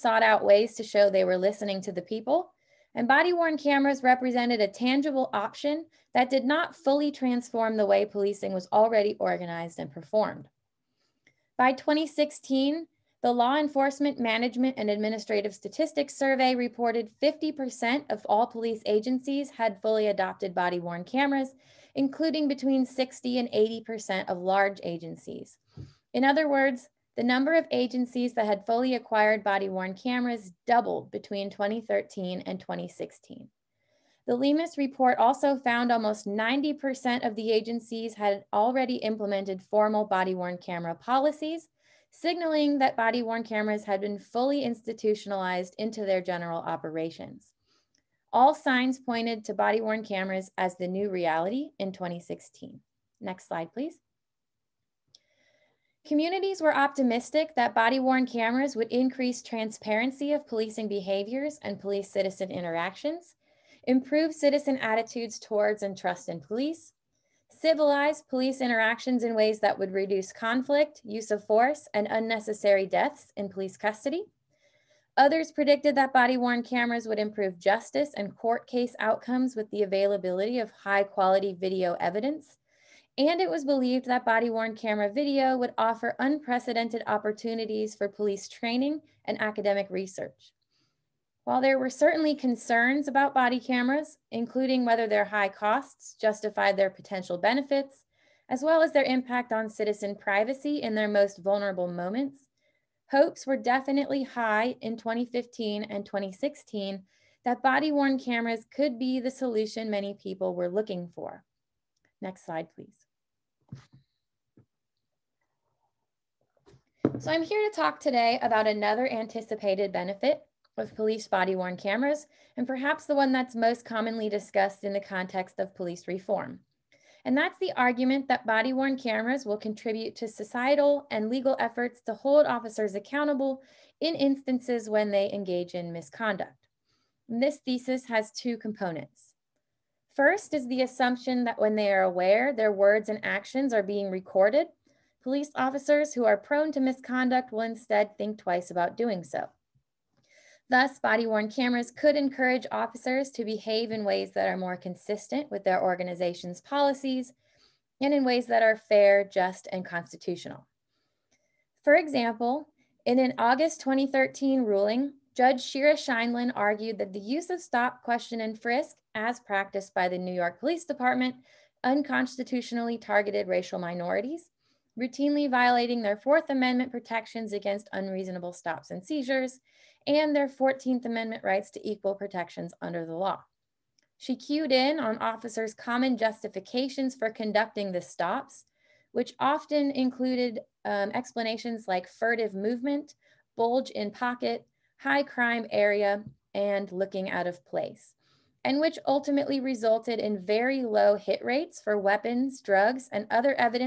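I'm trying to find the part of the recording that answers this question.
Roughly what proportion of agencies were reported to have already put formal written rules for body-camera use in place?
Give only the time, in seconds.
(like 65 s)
35 s.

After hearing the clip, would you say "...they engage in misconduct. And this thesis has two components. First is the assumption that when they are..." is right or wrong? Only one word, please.
right.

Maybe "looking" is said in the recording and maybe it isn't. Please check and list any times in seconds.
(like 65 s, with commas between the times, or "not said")
110 s, 196 s.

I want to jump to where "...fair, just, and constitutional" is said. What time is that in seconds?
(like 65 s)
158 s.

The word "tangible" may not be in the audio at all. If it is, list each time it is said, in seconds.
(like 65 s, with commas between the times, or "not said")
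4 s.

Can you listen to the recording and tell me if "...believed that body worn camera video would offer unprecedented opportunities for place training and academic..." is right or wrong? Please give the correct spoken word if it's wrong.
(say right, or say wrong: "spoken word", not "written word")
wrong: "police", not "place".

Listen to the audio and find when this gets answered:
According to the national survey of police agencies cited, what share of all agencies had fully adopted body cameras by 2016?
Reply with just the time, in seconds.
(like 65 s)
17 s.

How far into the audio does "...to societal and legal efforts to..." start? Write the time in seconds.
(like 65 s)
130 s.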